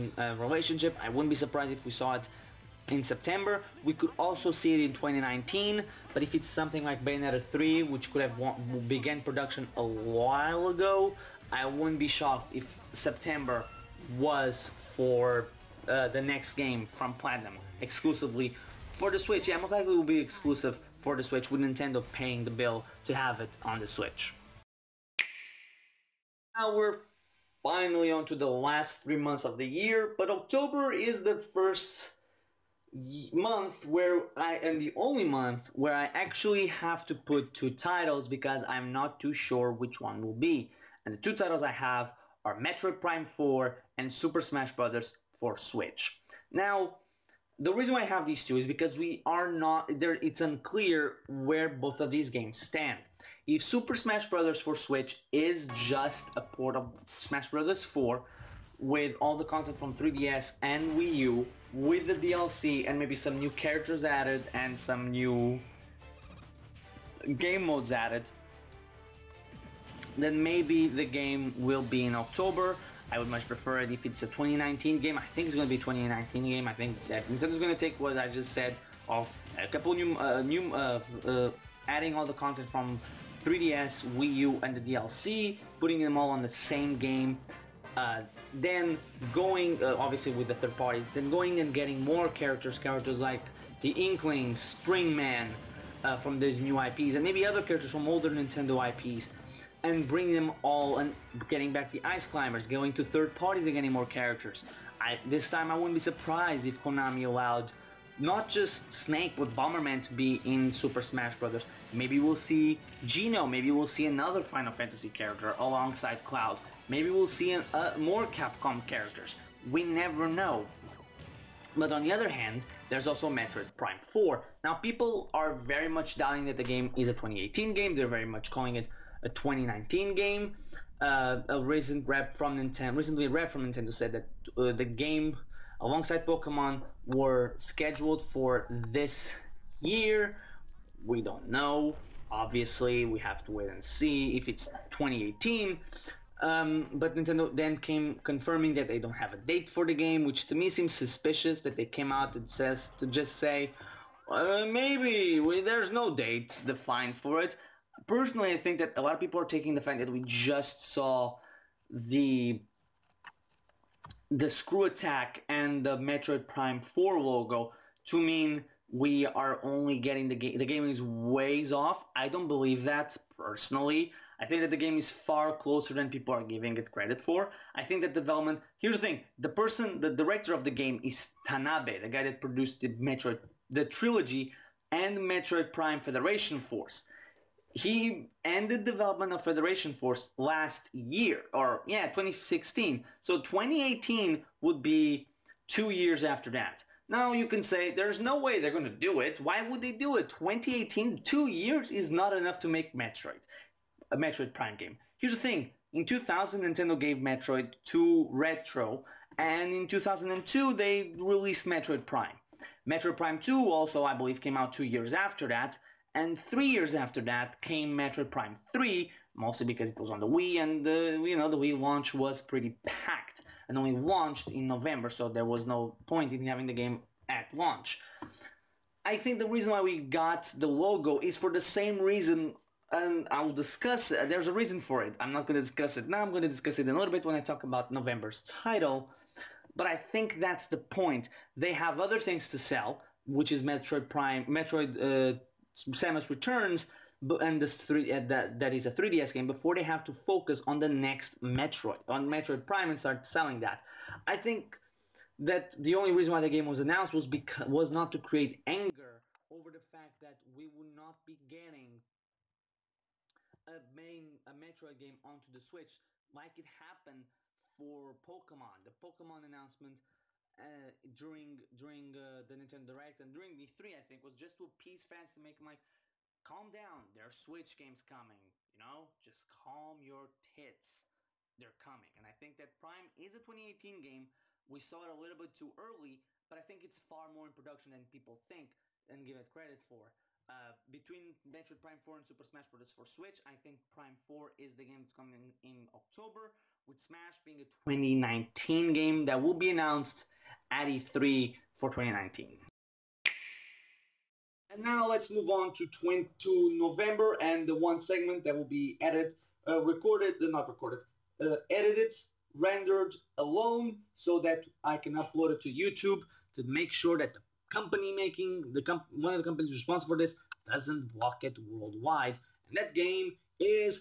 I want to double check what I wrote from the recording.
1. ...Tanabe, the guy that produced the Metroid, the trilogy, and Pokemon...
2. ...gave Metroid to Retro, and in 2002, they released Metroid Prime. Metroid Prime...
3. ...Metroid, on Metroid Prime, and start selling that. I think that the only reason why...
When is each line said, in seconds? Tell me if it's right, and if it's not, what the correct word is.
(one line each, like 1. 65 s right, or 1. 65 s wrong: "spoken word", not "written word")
1. 181 s wrong: "Metroid", not "Pokemon"
2. 206 s right
3. 251 s right.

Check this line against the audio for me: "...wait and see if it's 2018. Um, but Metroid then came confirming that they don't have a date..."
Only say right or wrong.
wrong.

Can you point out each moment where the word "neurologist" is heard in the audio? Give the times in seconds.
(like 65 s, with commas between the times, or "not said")
not said.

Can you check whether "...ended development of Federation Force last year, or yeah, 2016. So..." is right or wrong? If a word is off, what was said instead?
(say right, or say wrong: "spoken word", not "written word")
right.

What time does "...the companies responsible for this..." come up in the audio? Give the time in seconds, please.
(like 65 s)
319 s.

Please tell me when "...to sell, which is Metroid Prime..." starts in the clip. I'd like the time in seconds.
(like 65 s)
242 s.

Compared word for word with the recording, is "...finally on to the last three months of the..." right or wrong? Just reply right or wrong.
right.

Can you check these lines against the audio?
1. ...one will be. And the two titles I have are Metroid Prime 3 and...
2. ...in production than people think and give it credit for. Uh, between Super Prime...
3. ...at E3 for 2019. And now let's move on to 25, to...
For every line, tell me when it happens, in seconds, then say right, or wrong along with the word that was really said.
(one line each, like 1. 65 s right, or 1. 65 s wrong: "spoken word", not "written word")
1. 39 s wrong: "4", not "3"
2. 287 s wrong: "Metroid", not "Super"
3. 300 s wrong: "20", not "25".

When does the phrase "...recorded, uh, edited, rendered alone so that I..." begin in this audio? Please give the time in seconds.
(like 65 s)
310 s.